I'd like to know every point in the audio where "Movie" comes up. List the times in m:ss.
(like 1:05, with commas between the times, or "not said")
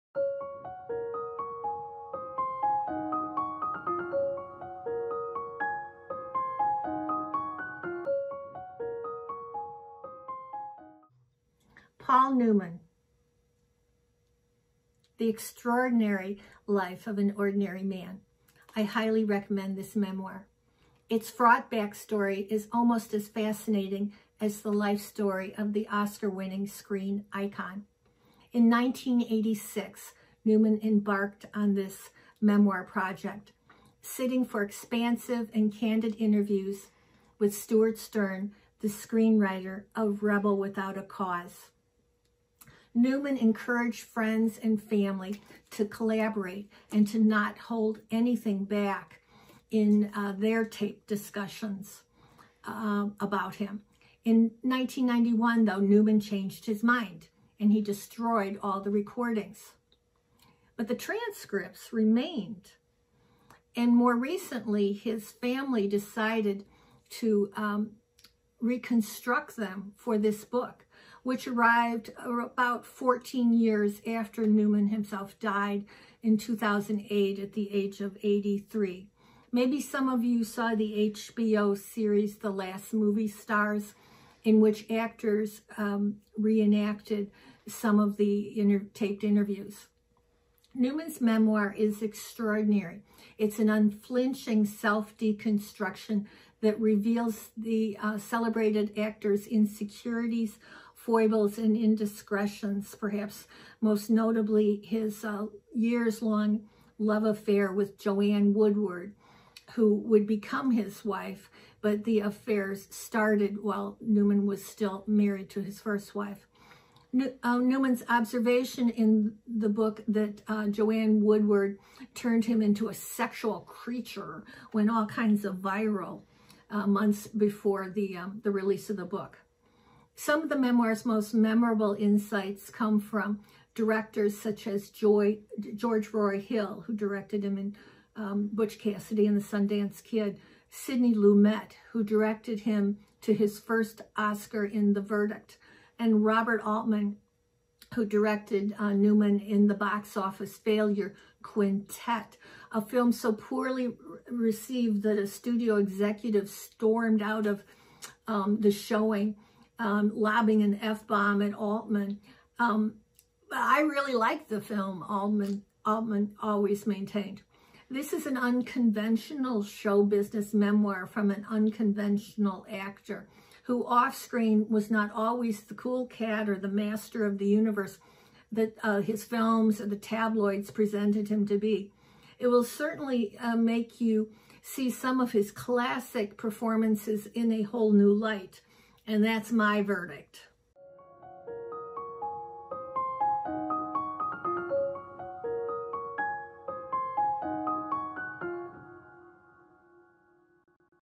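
1:22.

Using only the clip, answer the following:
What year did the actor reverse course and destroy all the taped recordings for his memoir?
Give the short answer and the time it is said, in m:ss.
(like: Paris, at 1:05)
1991, at 0:54.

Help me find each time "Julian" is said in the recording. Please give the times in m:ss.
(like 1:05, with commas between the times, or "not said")
not said.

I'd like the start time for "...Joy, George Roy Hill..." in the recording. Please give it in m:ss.
2:14.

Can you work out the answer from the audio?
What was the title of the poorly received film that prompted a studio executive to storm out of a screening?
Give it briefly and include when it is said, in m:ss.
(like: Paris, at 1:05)
Quintet, at 2:31.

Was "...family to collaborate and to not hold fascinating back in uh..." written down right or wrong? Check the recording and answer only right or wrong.
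wrong.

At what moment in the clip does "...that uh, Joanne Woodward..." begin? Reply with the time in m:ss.
2:00.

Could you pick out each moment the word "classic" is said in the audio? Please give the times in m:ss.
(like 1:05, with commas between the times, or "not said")
3:05.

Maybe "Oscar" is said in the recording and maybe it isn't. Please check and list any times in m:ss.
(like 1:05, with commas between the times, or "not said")
0:25, 2:24.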